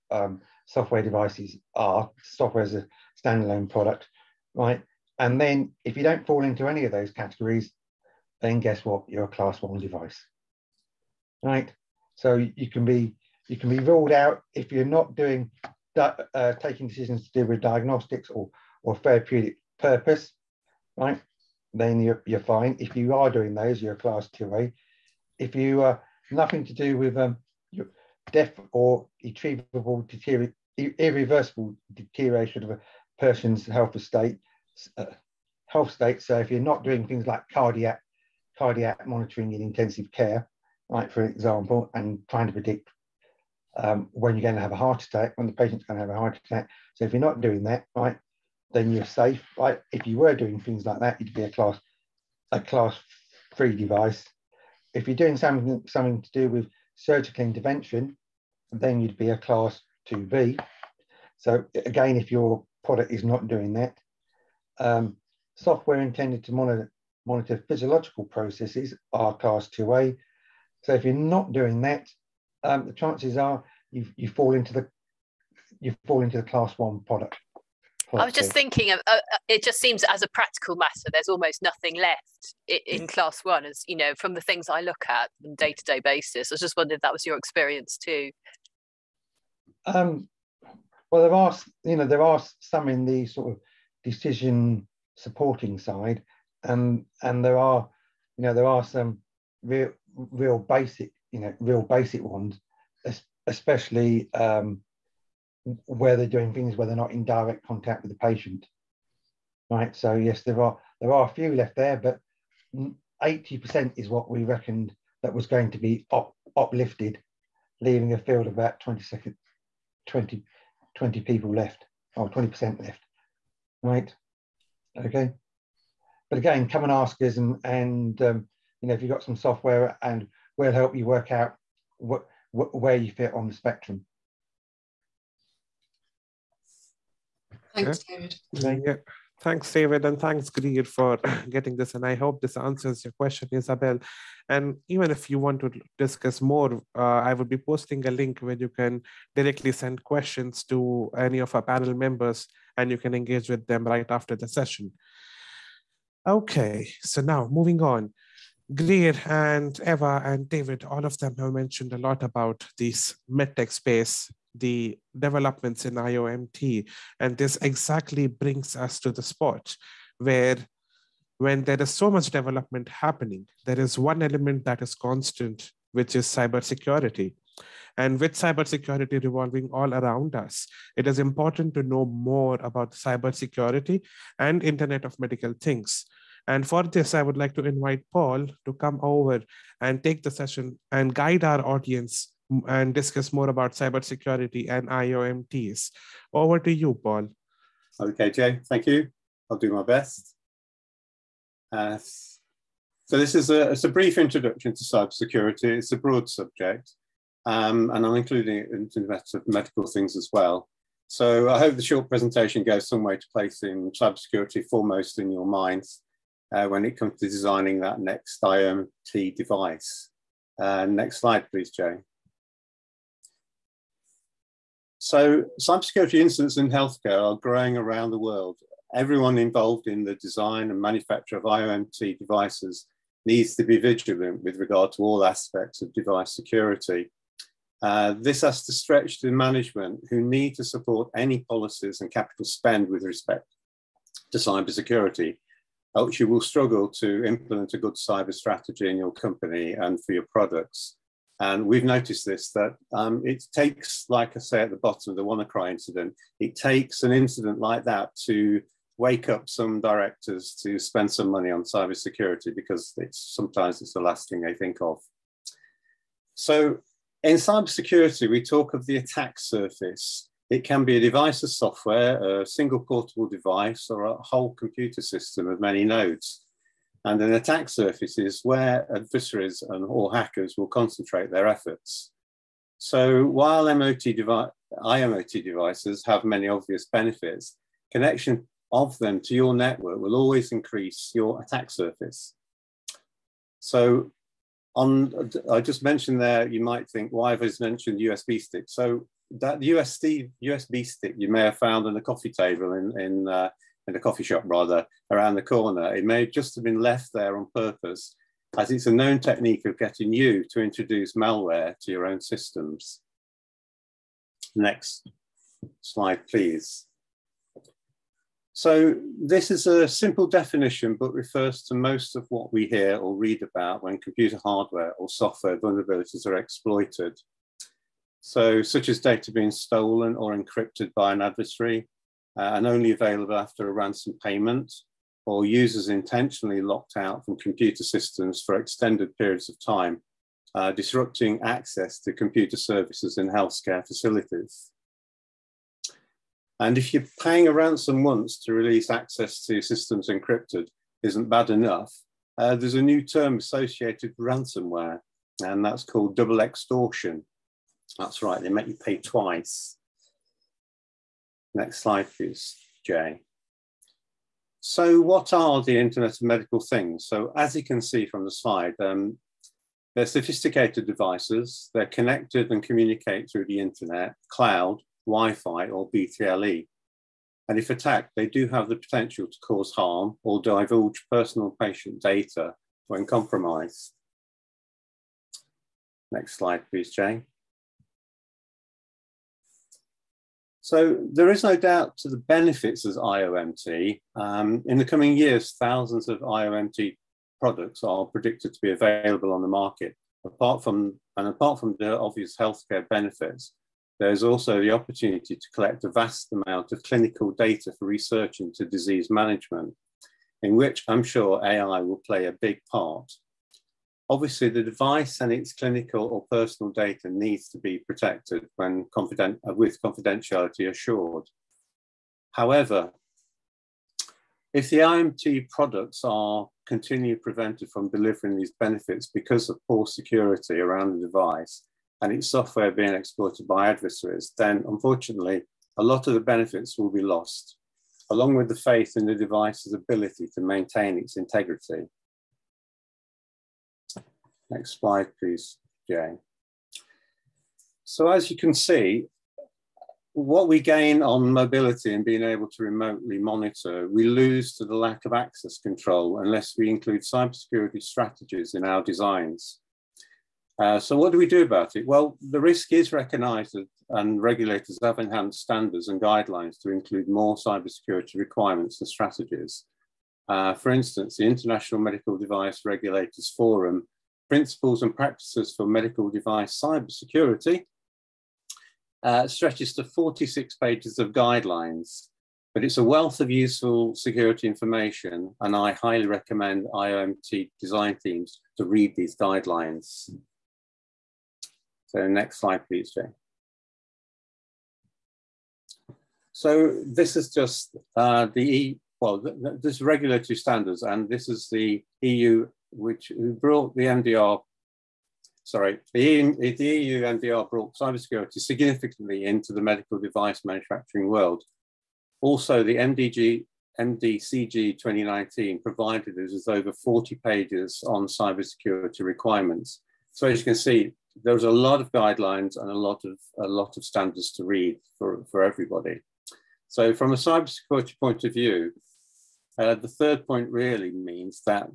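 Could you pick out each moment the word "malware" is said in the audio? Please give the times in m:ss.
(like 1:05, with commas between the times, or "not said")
5:11.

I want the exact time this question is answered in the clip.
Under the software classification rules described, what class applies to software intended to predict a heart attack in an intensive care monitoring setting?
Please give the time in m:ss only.
0:52.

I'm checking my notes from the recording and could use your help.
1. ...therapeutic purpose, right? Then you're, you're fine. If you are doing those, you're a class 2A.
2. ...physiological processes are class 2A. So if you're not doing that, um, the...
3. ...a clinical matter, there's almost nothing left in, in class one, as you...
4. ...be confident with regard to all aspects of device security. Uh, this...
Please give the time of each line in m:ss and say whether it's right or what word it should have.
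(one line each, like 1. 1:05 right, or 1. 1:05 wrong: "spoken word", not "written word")
1. 0:18 right
2. 1:07 right
3. 1:20 wrong: "practical", not "clinical"
4. 3:53 wrong: "vigilant", not "confident".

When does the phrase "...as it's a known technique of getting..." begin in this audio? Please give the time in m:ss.
5:08.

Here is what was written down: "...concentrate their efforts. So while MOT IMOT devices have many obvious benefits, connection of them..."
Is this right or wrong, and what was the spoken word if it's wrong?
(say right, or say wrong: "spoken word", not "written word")
right.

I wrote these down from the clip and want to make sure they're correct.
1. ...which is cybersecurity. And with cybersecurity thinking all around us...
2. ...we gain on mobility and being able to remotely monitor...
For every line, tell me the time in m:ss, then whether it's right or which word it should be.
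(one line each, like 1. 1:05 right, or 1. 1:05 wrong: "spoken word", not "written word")
1. 2:55 wrong: "revolving", not "thinking"
2. 7:30 right.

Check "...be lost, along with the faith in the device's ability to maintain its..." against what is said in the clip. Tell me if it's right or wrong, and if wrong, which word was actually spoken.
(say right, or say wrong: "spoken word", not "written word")
right.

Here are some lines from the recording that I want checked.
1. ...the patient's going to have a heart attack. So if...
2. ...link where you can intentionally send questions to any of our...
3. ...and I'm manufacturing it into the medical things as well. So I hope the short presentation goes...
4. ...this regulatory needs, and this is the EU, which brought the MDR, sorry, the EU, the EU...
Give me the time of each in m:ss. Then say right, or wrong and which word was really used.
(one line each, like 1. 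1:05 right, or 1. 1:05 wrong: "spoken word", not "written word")
1. 0:45 right
2. 2:28 wrong: "directly", not "intentionally"
3. 3:27 wrong: "including", not "manufacturing"
4. 8:19 wrong: "standards", not "needs".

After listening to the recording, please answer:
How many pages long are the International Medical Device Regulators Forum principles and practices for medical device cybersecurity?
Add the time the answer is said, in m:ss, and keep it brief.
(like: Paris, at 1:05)
46, at 7:59.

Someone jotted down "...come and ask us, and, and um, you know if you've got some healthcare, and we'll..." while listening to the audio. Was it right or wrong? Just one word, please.
wrong.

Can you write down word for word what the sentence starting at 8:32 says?
Also, the MDG, MDCG 2019 provided us with over 40 pages on cybersecurity requirements.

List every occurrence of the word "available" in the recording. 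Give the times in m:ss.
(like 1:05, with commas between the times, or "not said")
5:32, 6:38.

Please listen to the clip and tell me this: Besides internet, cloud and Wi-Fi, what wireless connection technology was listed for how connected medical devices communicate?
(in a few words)
BTLE.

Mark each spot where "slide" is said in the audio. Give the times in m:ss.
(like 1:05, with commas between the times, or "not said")
3:41, 5:15, 6:01, 6:08, 6:26, 7:24, 8:12.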